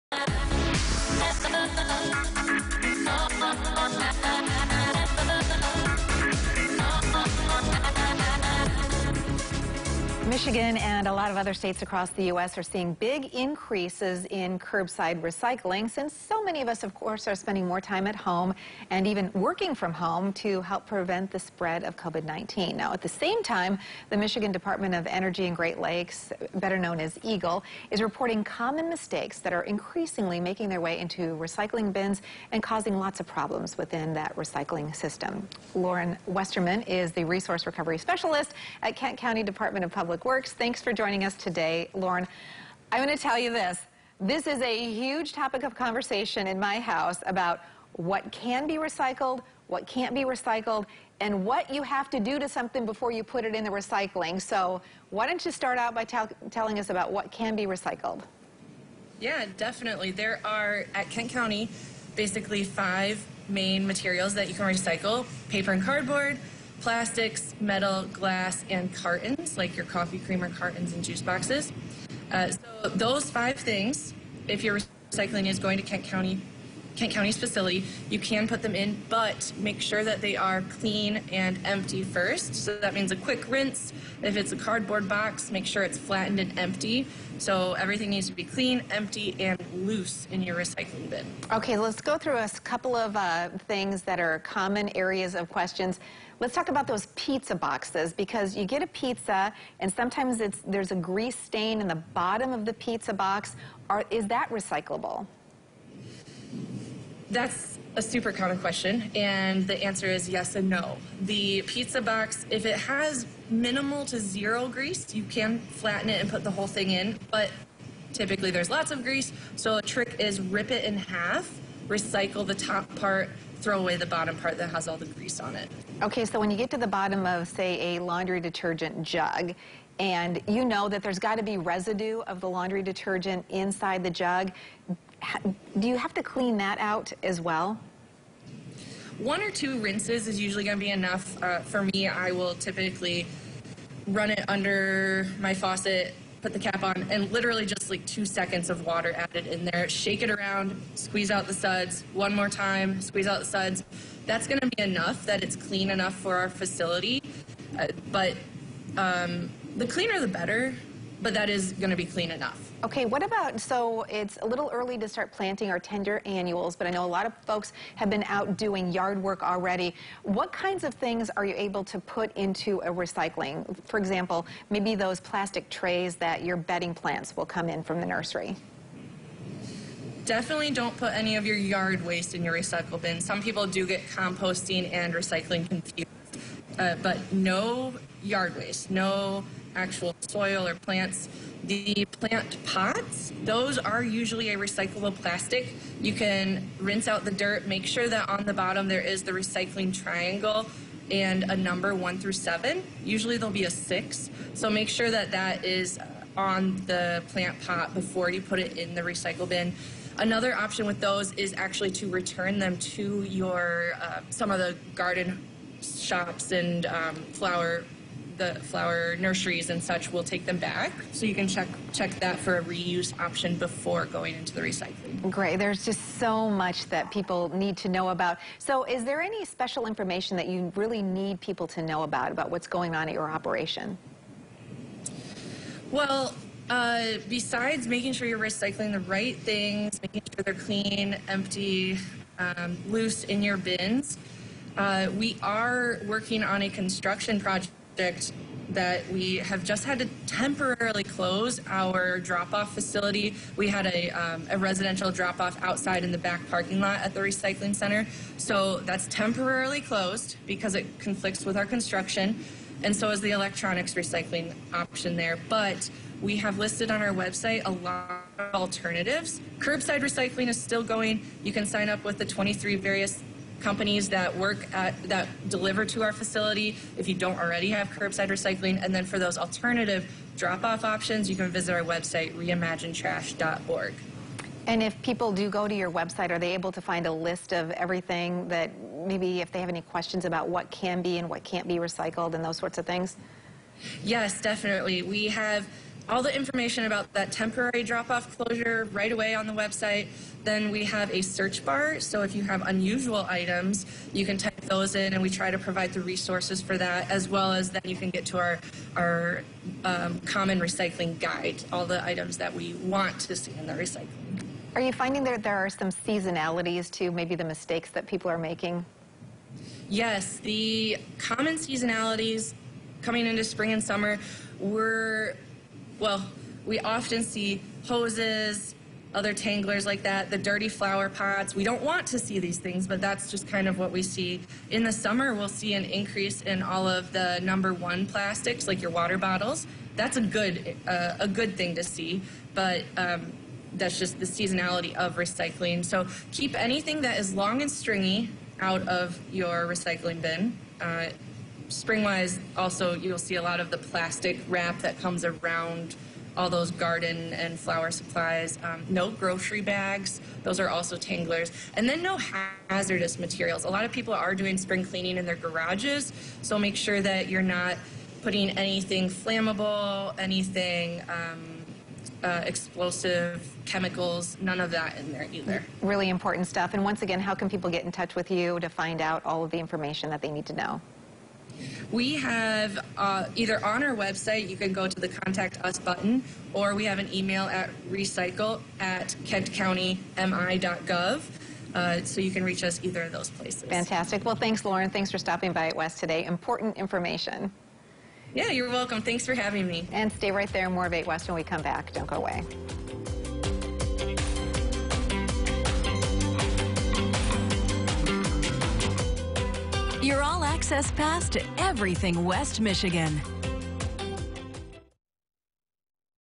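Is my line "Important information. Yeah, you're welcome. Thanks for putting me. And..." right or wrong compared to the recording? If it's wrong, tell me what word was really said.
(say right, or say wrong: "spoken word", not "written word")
wrong: "having", not "putting".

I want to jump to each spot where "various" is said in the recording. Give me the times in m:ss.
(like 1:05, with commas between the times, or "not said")
4:32.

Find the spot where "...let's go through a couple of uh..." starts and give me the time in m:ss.
1:31.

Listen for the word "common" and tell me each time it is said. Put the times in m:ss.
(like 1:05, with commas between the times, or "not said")
0:28, 1:34, 1:48, 5:10, 5:21.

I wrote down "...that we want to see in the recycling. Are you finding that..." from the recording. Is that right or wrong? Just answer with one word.
right.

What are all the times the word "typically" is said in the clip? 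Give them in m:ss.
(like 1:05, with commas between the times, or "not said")
1:58, 2:22.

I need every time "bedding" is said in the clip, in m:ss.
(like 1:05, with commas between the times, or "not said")
2:56.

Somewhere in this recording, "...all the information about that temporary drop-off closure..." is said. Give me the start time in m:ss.
4:56.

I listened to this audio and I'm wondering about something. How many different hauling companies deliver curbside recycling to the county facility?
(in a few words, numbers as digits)
23.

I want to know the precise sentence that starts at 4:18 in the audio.
So that's temporarily closed because it conflicts with our construction.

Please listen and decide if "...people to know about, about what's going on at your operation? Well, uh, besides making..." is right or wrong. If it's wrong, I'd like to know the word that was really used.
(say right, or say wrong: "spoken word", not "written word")
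right.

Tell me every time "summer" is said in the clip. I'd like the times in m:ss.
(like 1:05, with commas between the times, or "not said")
5:23, 5:34.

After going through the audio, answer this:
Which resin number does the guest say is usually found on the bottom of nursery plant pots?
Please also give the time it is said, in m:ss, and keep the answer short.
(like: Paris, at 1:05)
6, at 3:23.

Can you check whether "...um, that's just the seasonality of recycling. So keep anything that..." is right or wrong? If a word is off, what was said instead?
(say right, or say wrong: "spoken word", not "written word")
right.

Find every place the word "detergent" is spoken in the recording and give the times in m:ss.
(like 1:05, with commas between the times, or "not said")
2:08, 2:12.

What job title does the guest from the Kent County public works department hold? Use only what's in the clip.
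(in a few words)
Resource Recovery Specialist.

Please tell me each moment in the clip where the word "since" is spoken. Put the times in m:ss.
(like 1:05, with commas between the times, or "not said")
0:15.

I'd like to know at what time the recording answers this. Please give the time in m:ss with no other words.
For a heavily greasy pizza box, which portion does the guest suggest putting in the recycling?
2:02.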